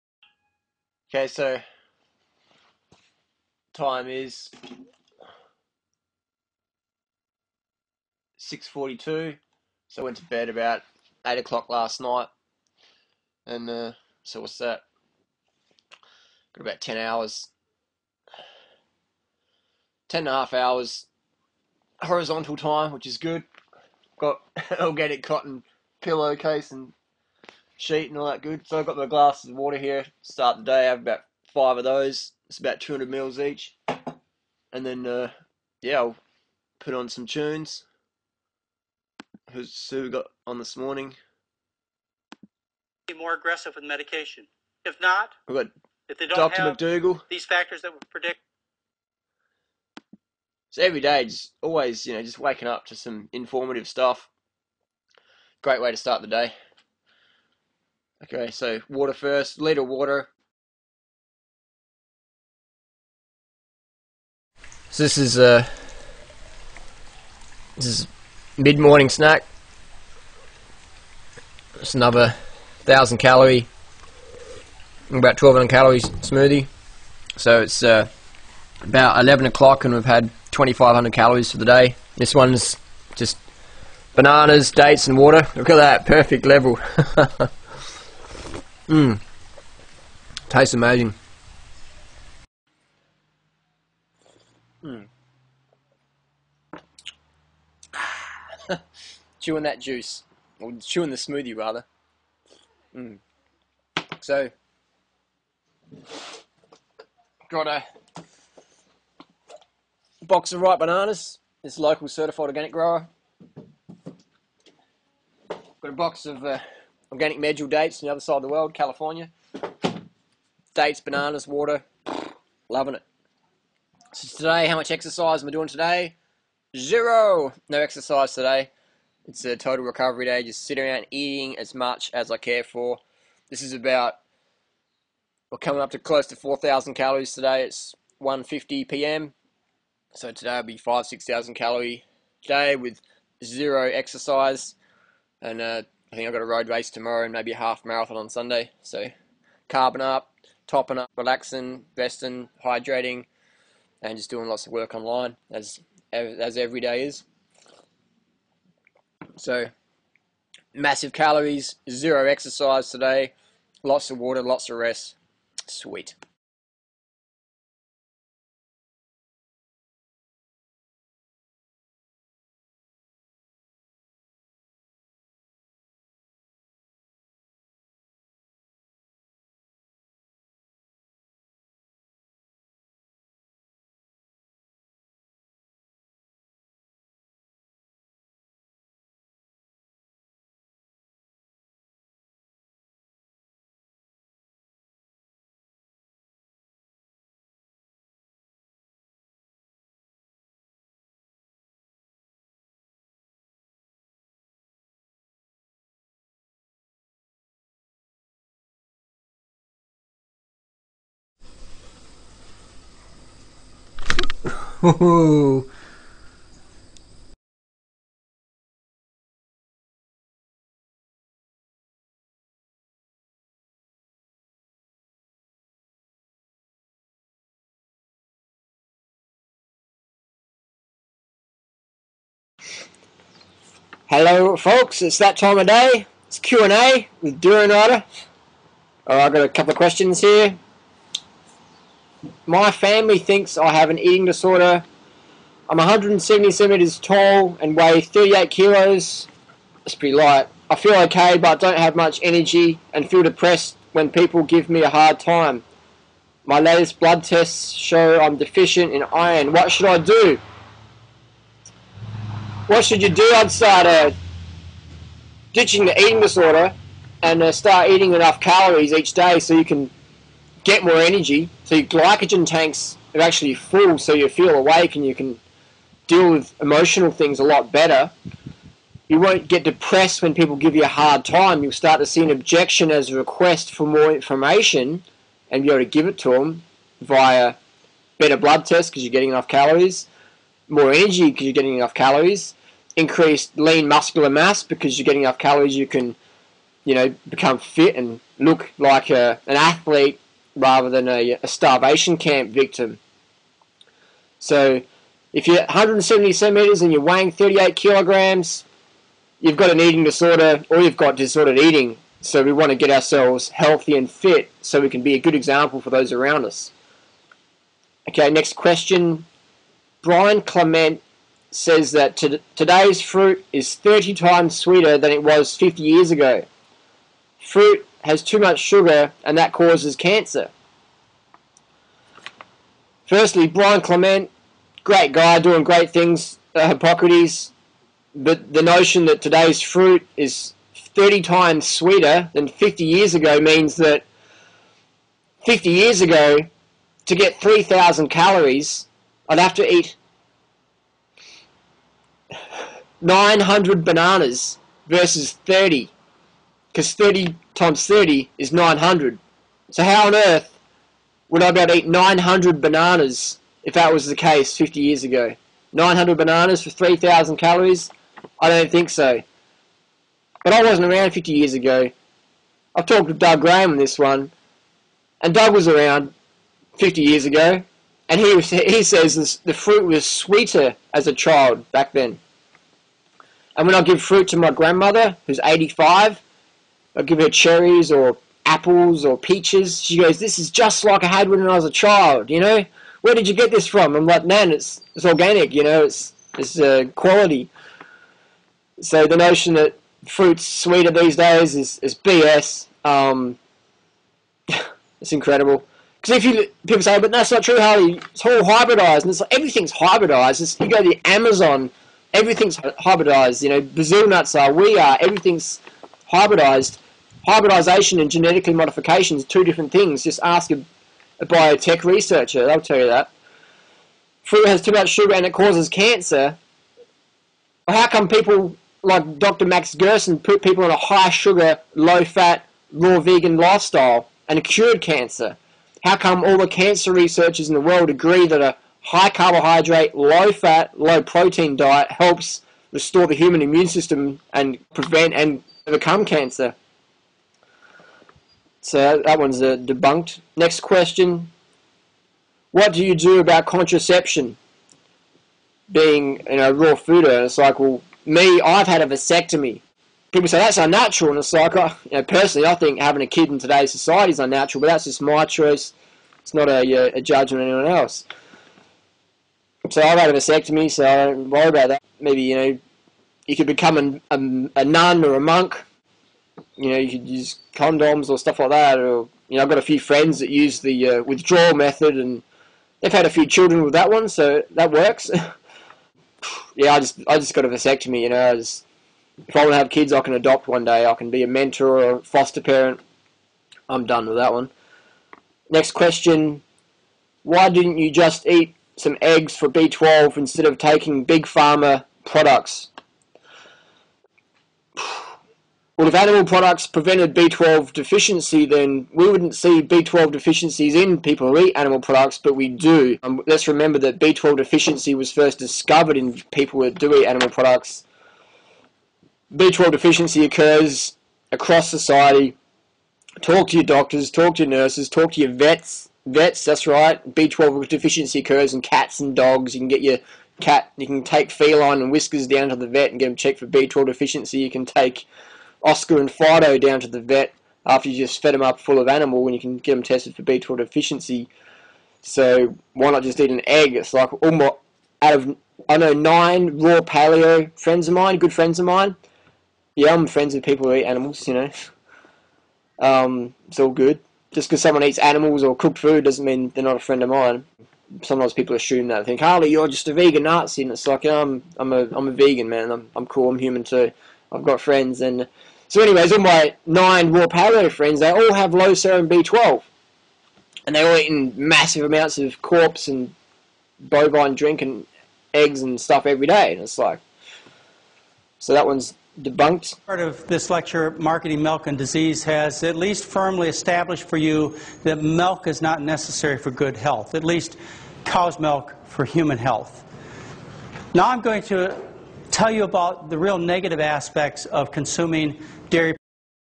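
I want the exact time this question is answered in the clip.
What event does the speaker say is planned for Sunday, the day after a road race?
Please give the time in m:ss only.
2:27.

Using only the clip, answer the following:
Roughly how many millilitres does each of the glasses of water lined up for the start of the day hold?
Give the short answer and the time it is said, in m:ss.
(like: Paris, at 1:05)
200, at 0:32.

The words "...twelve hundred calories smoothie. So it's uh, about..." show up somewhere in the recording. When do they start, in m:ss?
1:15.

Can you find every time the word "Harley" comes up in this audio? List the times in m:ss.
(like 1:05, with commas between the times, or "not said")
6:47, 9:19.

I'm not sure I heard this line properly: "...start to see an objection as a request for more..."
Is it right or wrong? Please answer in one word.
right.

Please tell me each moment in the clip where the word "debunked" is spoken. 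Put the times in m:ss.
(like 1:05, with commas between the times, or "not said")
7:29, 9:39.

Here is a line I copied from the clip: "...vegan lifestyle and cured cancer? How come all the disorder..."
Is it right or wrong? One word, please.
wrong.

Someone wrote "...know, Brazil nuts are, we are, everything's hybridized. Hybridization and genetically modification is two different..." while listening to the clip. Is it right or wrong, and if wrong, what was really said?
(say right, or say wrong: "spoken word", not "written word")
right.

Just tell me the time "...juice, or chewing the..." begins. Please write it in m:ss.
1:39.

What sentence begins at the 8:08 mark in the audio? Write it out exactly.
You know, I just, if I want to have kids, I can adopt one day.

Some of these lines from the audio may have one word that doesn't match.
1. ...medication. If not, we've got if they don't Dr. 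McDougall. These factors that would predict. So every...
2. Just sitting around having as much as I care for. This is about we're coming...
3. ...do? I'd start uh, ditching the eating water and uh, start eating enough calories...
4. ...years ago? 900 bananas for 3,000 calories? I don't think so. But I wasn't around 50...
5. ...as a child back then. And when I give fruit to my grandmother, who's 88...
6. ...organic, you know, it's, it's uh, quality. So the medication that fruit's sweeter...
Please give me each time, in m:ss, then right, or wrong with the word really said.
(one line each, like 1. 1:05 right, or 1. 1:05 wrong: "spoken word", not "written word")
1. 0:43 right
2. 2:10 wrong: "eating", not "having"
3. 4:23 wrong: "disorder", not "water"
4. 6:04 right
5. 6:20 wrong: "85", not "88"
6. 6:35 wrong: "notion", not "medication".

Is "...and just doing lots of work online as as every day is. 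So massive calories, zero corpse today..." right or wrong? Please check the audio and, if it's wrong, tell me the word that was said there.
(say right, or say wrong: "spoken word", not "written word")
wrong: "exercise", not "corpse".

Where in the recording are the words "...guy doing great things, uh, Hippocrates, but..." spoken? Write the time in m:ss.
5:35.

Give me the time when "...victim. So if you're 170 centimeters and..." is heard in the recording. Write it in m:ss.
5:02.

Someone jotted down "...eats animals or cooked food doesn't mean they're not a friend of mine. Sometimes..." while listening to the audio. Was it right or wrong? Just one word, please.
right.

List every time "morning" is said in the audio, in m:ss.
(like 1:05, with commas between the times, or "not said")
0:40, 1:08.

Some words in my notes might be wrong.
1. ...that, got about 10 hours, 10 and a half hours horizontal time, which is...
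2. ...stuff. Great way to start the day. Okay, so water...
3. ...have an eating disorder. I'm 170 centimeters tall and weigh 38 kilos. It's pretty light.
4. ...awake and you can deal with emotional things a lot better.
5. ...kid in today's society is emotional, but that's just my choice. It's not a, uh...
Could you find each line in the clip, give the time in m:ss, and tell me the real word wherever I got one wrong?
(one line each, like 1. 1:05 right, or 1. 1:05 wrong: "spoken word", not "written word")
1. 0:14 right
2. 0:53 right
3. 4:03 right
4. 4:34 right
5. 7:43 wrong: "unnatural", not "emotional".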